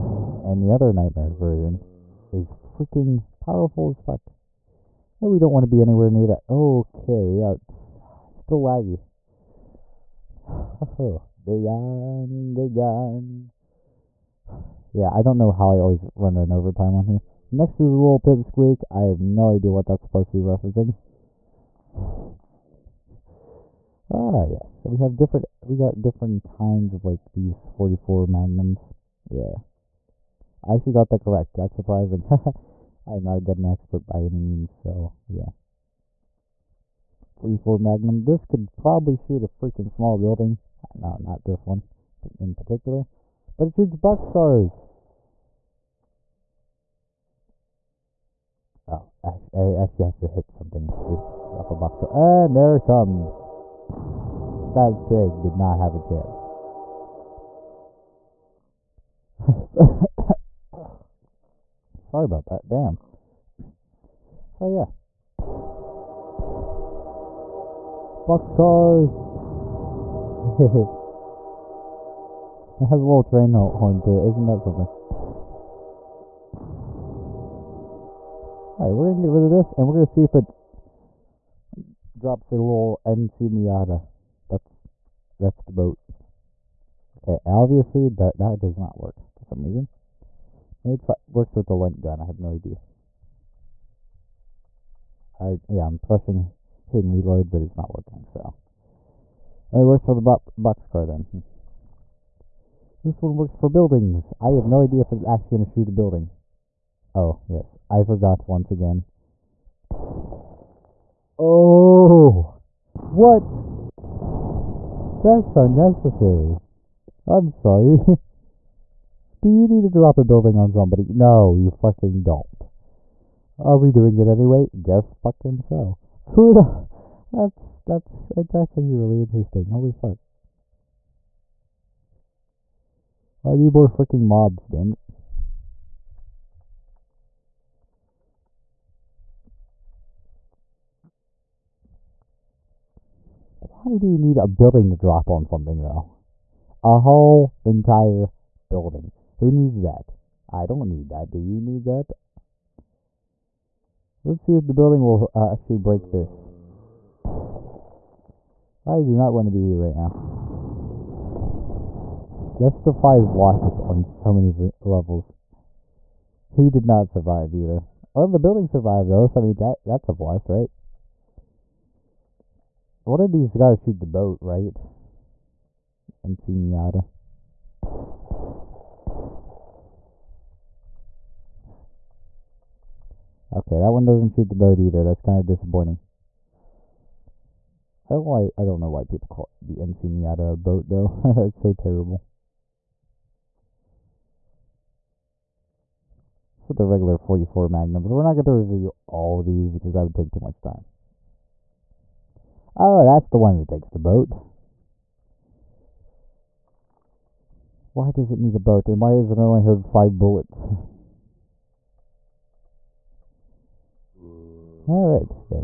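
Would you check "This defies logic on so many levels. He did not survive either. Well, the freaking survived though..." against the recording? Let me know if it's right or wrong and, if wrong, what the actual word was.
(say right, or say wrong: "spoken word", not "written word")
wrong: "building", not "freaking".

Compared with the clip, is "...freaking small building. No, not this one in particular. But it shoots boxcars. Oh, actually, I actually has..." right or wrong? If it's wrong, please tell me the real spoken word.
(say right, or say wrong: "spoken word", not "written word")
right.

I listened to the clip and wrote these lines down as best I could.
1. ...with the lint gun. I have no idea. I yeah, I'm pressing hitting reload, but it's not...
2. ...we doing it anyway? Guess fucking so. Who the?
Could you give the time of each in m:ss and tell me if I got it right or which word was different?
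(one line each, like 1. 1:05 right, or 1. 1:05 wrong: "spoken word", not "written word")
1. 1:31 right
2. 2:03 right.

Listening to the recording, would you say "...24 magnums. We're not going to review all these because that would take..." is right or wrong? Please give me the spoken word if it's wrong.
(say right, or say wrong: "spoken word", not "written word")
wrong: "44", not "24".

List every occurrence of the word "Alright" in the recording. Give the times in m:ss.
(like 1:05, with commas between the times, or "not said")
1:18, 3:34.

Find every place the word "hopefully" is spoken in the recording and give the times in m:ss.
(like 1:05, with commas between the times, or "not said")
not said.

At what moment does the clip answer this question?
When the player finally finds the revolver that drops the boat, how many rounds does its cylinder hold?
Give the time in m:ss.
3:29.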